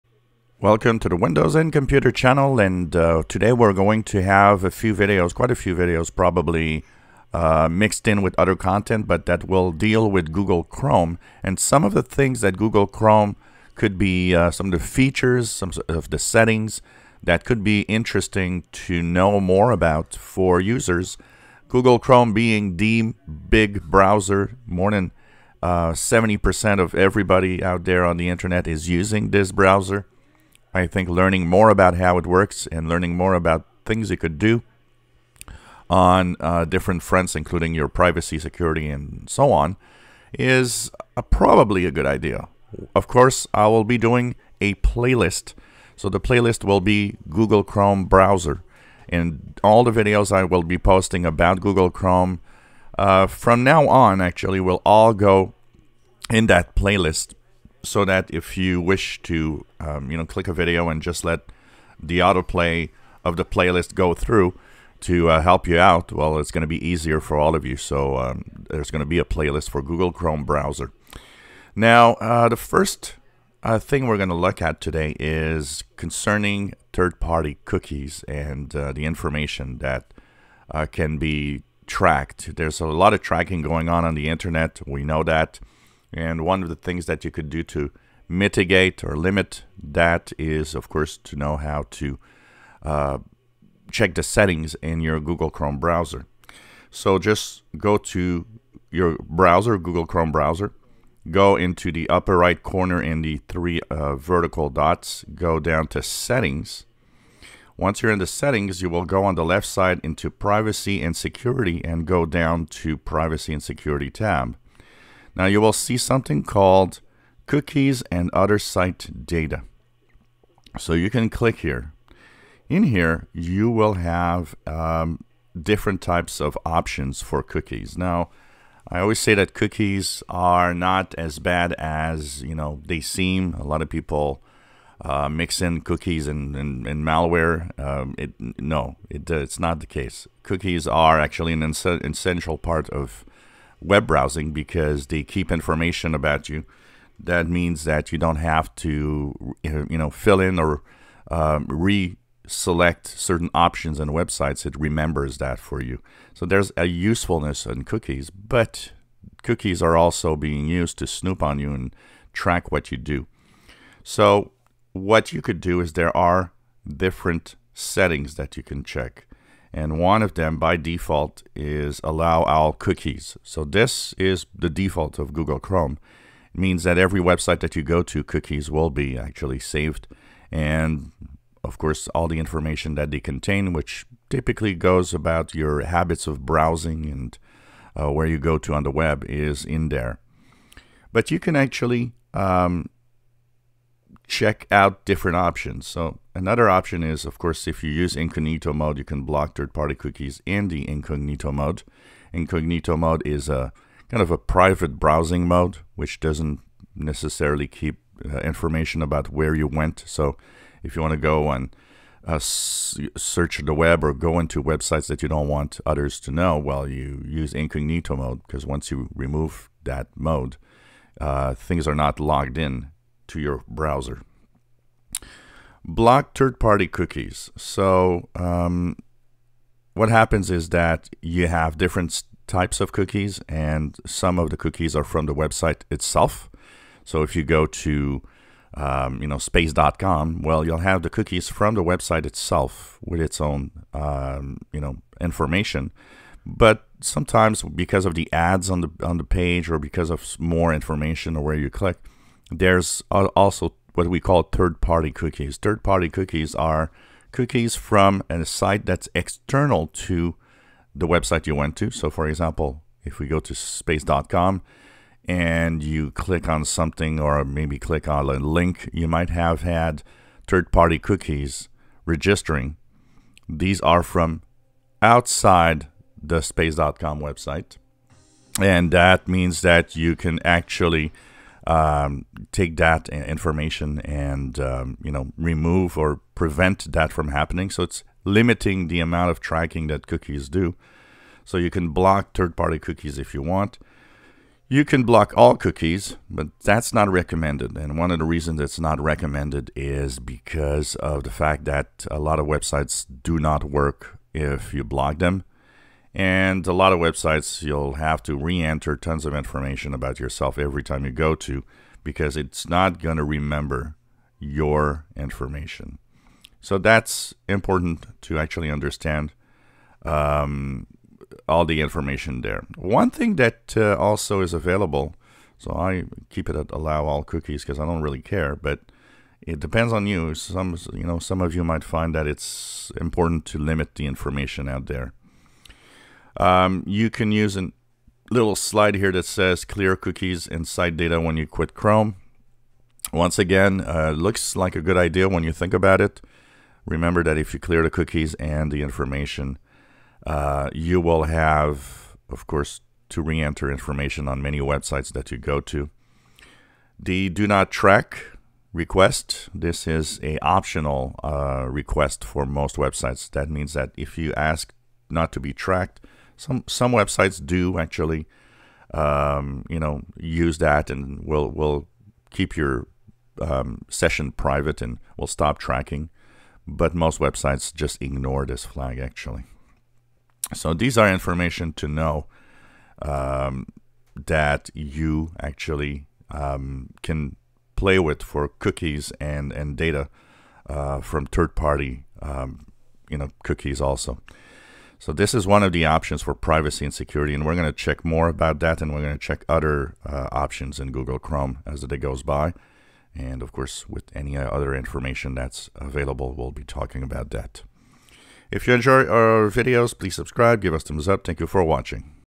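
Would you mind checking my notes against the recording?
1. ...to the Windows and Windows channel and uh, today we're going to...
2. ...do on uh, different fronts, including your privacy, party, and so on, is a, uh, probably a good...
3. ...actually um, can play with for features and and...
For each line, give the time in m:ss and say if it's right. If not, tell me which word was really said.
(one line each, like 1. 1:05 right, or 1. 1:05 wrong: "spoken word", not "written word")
1. 0:00 wrong: "Computer", not "Windows"
2. 0:34 wrong: "security", not "party"
3. 6:25 wrong: "cookies", not "features".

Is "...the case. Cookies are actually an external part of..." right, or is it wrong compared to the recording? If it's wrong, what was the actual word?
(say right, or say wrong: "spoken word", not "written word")
wrong: "essential", not "external".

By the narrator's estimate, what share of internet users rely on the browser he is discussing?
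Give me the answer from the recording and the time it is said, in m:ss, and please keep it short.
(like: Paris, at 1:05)
more than 70%, at 0:24.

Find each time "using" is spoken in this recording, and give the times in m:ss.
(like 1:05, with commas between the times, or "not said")
0:28.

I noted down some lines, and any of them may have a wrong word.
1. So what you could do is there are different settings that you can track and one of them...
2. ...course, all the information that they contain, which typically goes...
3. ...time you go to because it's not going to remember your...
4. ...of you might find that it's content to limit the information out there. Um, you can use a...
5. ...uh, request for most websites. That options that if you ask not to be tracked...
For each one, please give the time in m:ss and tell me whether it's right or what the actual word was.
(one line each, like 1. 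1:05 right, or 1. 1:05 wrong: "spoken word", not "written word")
1. 2:44 wrong: "check", not "track"
2. 3:01 right
3. 5:10 right
4. 5:31 wrong: "important", not "content"
5. 6:01 wrong: "means", not "options".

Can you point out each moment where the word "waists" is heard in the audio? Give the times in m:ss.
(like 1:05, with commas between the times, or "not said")
not said.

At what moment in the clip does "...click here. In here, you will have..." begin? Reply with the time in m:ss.
2:01.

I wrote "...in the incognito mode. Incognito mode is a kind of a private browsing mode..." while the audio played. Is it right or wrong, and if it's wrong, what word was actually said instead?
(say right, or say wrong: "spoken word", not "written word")
right.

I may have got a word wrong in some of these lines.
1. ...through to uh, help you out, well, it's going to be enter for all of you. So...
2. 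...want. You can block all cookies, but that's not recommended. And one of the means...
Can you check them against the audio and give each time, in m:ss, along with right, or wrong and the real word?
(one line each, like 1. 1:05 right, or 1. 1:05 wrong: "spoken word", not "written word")
1. 1:04 wrong: "easier", not "enter"
2. 4:53 wrong: "reasons", not "means".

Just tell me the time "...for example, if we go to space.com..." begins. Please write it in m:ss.
4:22.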